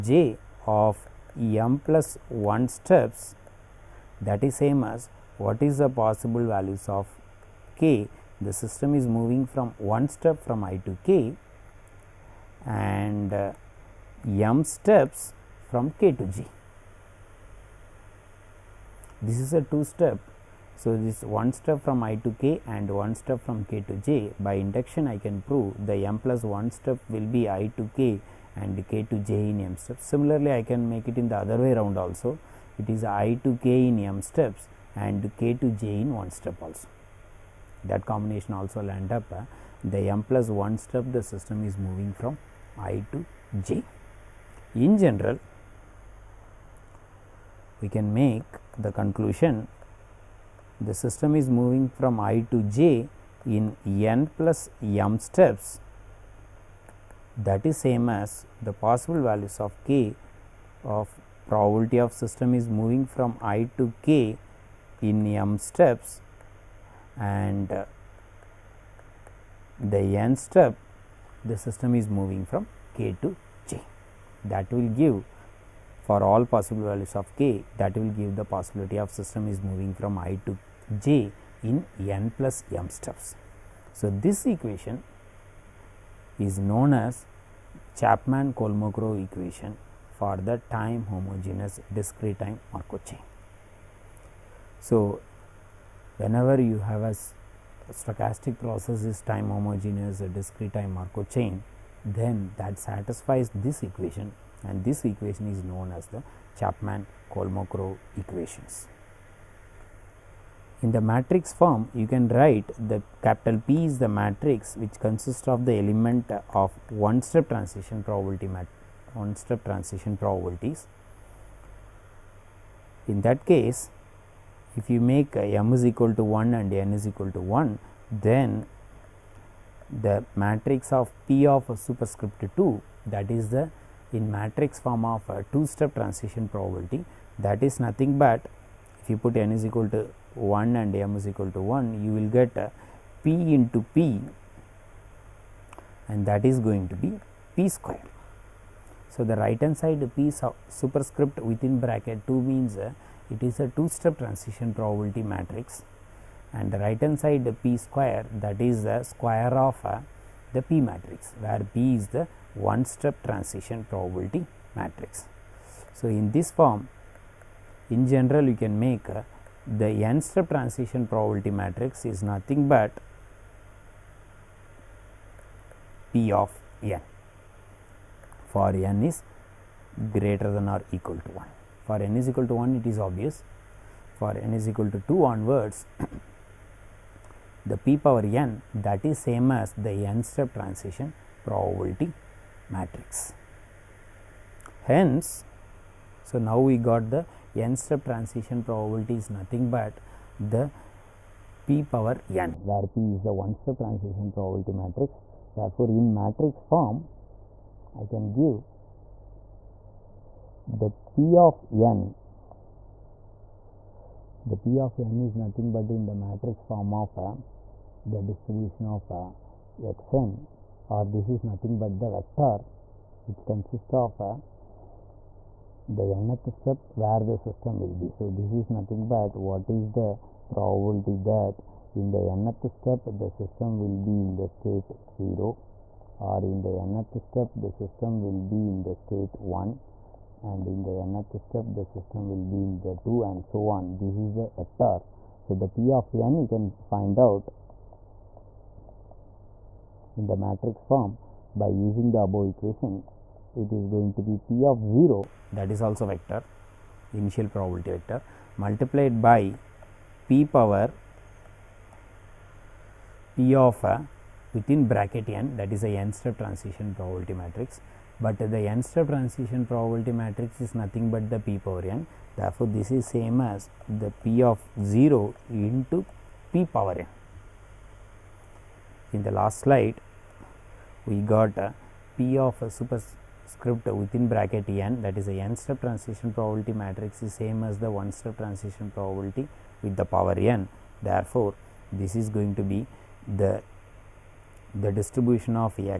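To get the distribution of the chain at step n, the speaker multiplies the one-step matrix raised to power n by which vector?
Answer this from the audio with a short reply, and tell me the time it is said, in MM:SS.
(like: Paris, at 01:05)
initial probability vector, at 04:17.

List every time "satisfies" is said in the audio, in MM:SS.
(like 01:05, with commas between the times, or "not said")
01:42.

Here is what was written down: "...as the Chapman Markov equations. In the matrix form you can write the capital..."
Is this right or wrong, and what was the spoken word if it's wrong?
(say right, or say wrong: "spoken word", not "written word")
wrong: "Kolmogorov", not "Markov".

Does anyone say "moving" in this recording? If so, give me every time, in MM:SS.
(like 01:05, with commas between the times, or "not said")
00:09, 00:41, 00:51, 01:02, 01:12, 01:19.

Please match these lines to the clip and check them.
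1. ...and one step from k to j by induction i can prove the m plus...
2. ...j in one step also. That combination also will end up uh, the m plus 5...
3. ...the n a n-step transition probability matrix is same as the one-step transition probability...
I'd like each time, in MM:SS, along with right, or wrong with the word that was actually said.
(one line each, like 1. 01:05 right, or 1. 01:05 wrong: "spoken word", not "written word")
1. 00:22 right
2. 00:35 wrong: "1", not "5"
3. 04:45 right.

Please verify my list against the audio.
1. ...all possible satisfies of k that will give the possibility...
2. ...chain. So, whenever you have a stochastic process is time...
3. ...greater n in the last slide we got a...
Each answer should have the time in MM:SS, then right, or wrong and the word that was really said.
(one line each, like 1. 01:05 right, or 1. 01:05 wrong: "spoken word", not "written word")
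1. 01:16 wrong: "values", not "satisfies"
2. 01:33 right
3. 04:36 wrong: "power", not "greater".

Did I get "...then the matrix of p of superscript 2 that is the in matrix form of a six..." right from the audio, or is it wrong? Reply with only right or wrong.
wrong.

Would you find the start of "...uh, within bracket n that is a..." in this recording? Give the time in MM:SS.
04:23.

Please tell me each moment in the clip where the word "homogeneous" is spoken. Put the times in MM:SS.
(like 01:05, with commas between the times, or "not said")
01:31, 01:39.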